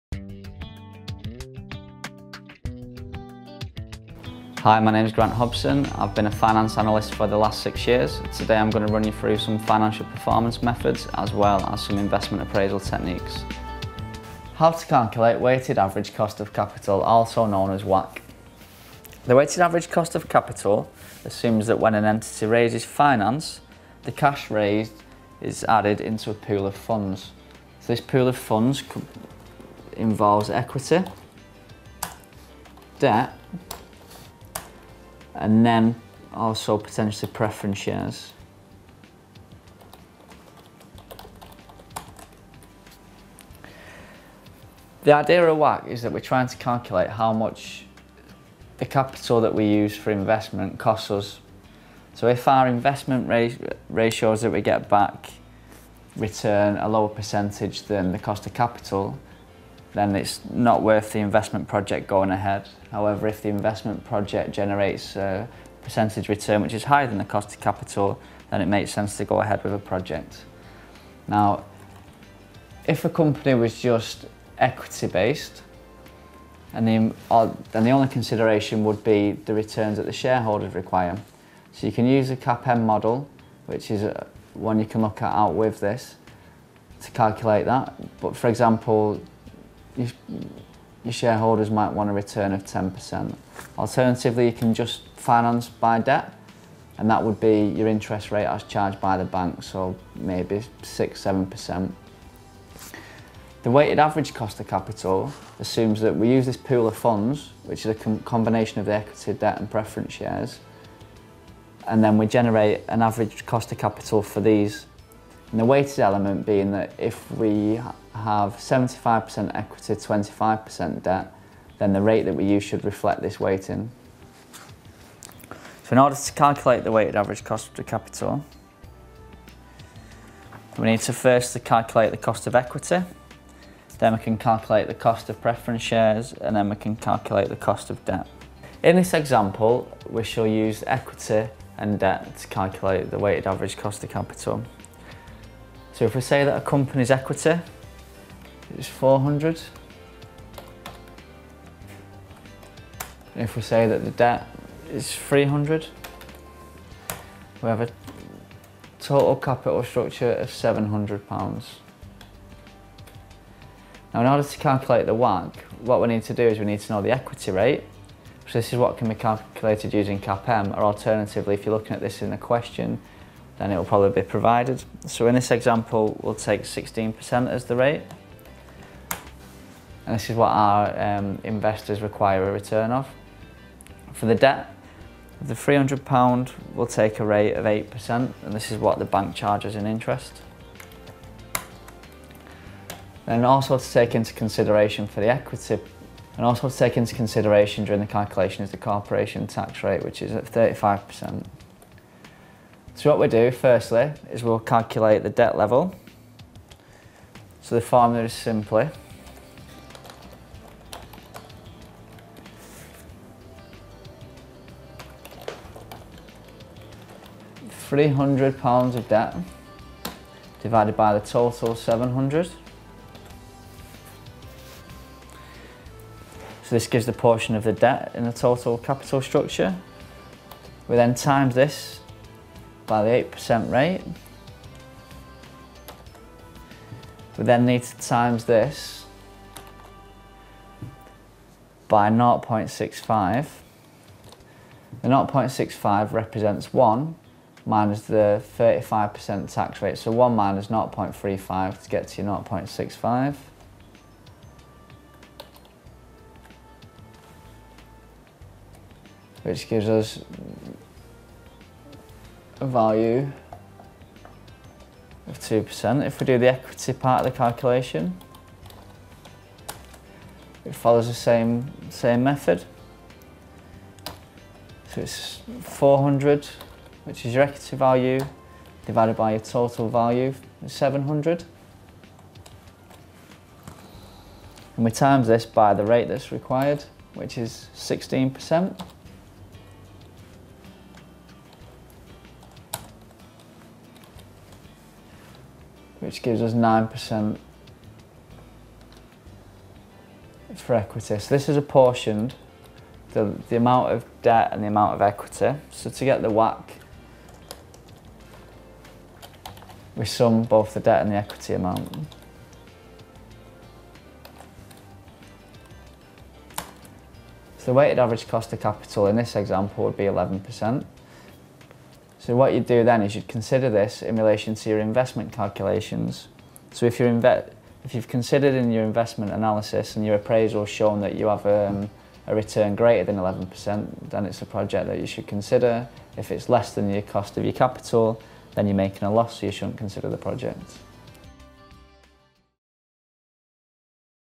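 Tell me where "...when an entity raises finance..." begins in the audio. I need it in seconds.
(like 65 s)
21 s.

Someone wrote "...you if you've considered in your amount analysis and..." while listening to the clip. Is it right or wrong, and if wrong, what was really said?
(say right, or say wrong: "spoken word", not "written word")
wrong: "investment", not "amount".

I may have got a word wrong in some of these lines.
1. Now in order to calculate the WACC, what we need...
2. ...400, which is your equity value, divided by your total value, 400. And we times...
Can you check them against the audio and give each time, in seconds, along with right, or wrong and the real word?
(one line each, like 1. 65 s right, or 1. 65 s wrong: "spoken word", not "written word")
1. 164 s right
2. 275 s wrong: "700", not "400".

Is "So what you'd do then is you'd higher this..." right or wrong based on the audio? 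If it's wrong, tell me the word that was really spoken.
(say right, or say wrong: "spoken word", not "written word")
wrong: "consider", not "higher".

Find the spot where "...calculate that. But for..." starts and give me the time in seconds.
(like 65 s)
87 s.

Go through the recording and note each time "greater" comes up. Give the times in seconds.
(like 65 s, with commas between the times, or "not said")
332 s.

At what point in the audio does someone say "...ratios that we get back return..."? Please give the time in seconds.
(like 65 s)
53 s.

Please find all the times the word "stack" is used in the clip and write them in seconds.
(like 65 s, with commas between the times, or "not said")
not said.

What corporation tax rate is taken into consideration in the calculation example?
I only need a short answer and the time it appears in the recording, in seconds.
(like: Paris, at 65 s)
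35%, at 200 s.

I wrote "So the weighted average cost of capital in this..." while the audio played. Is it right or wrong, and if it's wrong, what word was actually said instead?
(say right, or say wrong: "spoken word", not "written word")
right.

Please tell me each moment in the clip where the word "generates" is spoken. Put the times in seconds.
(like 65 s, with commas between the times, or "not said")
64 s, 112 s.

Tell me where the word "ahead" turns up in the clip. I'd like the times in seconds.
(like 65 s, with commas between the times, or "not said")
62 s, 69 s.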